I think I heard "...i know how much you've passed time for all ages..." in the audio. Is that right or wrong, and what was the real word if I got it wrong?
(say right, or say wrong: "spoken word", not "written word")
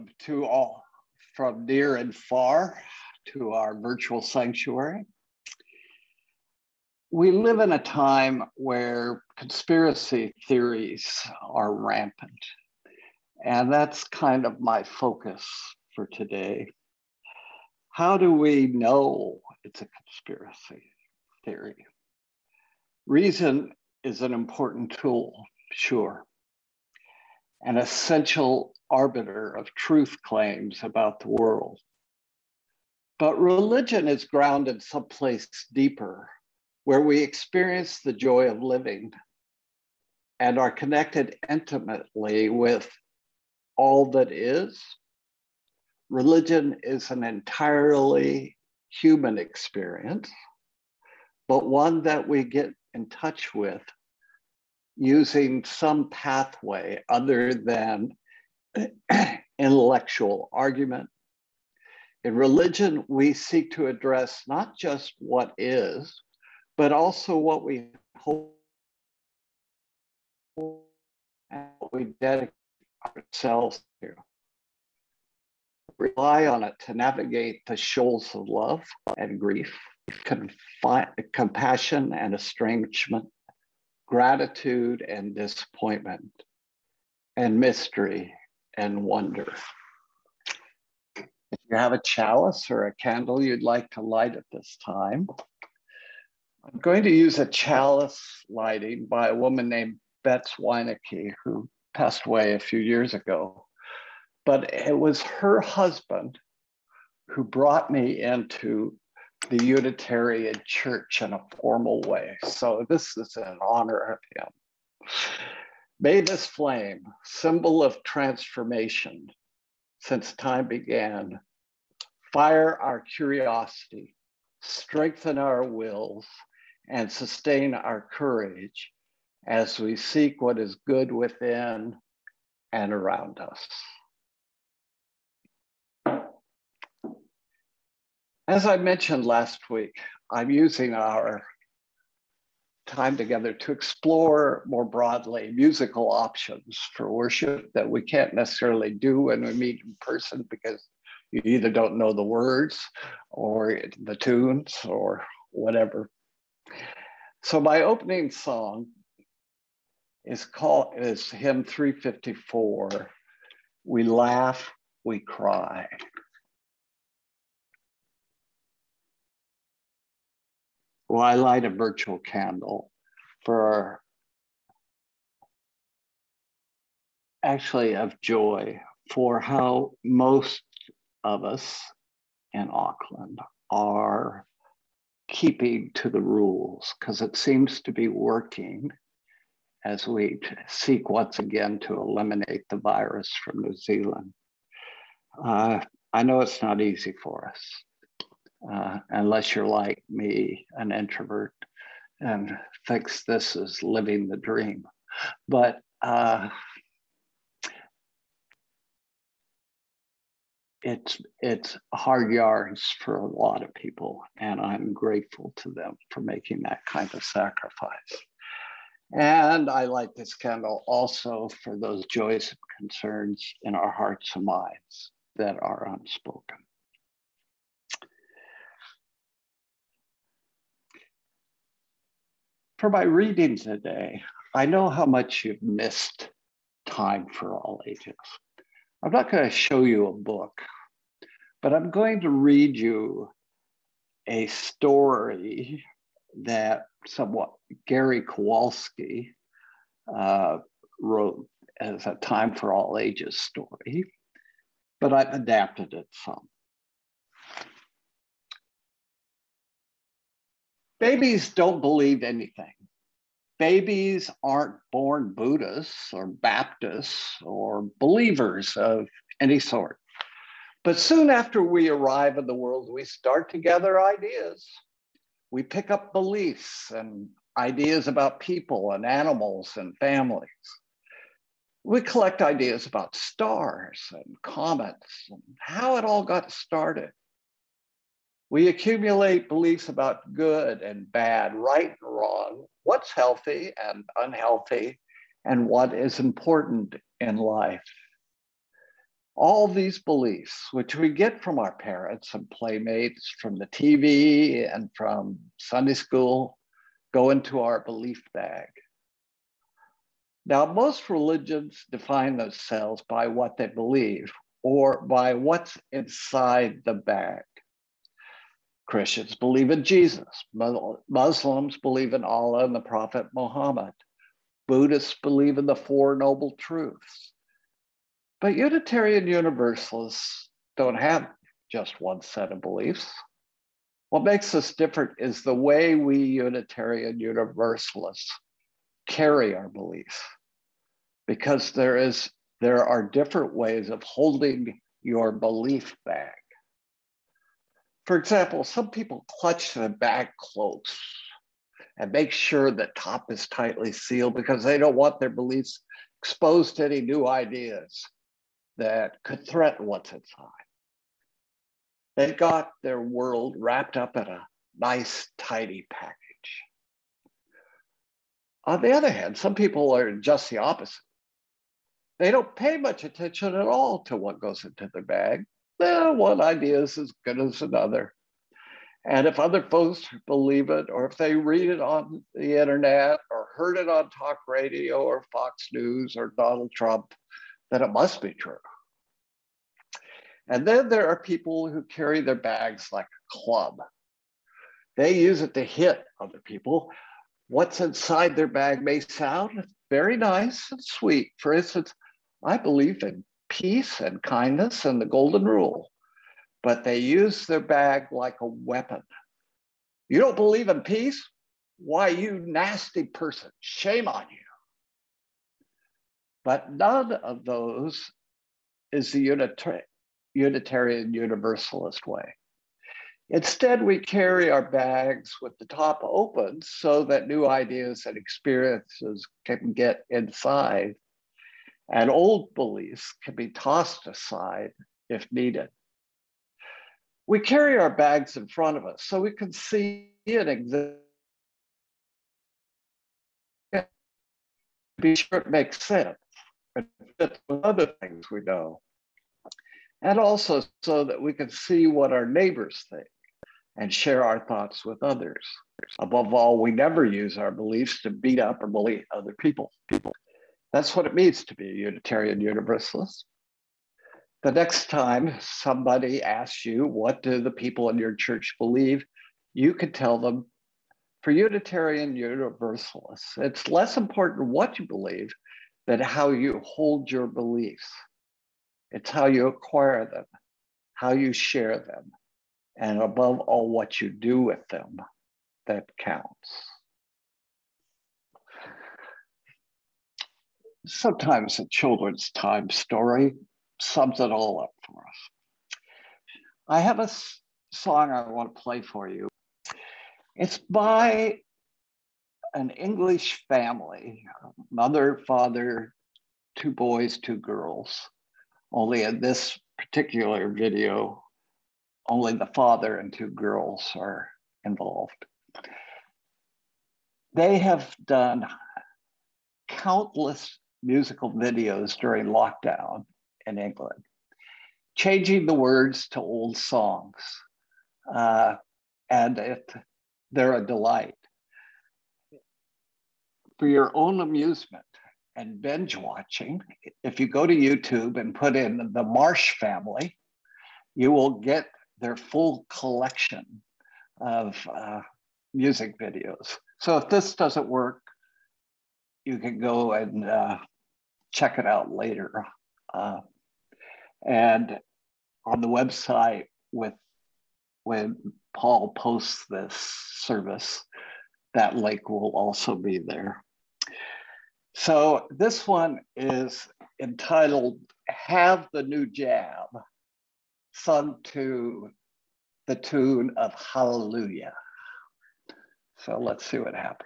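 wrong: "missed", not "passed".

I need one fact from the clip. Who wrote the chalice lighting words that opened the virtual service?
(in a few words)
Bets Wienecke.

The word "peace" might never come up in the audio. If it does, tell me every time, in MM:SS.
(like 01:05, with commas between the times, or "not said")
06:43, 06:50.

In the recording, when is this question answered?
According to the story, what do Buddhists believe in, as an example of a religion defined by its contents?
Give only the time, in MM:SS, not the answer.
05:25.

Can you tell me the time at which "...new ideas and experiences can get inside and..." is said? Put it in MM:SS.
07:07.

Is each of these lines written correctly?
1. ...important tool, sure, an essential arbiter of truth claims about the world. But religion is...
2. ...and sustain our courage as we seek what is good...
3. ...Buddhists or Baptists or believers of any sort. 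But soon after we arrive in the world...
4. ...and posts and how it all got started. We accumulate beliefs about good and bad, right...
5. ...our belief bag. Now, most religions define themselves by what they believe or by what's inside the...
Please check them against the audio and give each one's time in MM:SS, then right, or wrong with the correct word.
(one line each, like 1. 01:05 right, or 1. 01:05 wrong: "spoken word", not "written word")
1. 00:24 right
2. 02:06 right
3. 04:25 right
4. 04:44 wrong: "comets", not "posts"
5. 05:07 right.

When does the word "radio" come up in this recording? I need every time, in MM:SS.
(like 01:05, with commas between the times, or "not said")
06:24.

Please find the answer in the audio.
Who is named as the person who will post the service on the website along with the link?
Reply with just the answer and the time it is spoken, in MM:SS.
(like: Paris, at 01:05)
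Paul, at 09:18.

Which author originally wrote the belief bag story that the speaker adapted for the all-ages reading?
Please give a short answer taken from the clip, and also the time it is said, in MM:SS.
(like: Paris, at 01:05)
Gary Kowalski, at 04:07.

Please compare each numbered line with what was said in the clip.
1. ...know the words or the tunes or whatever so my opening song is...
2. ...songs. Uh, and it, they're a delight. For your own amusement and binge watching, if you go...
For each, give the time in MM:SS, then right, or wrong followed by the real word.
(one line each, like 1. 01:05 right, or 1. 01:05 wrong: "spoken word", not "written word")
1. 02:31 right
2. 08:46 right.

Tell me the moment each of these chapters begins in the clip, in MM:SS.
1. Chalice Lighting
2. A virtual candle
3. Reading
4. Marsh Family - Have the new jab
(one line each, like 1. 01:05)
1. 01:30
2. 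02:48
3. 03:49
4. 08:14.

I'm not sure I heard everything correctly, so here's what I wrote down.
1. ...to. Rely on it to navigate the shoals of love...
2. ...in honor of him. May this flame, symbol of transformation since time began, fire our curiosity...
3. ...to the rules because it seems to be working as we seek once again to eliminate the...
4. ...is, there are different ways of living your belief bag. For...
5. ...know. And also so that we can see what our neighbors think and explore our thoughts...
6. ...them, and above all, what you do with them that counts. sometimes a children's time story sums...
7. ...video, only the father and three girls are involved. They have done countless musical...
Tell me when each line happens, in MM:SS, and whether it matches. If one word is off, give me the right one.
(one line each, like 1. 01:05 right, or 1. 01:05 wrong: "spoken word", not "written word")
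1. 01:14 right
2. 01:53 right
3. 03:05 right
4. 05:41 wrong: "holding", not "living"
5. 07:28 wrong: "share", not "explore"
6. 08:01 right
7. 08:30 wrong: "two", not "three".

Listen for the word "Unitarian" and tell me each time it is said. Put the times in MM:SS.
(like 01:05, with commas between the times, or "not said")
01:49, 05:28, 05:36, 07:00, 07:41, 07:51.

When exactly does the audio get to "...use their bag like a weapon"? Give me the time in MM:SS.
06:46.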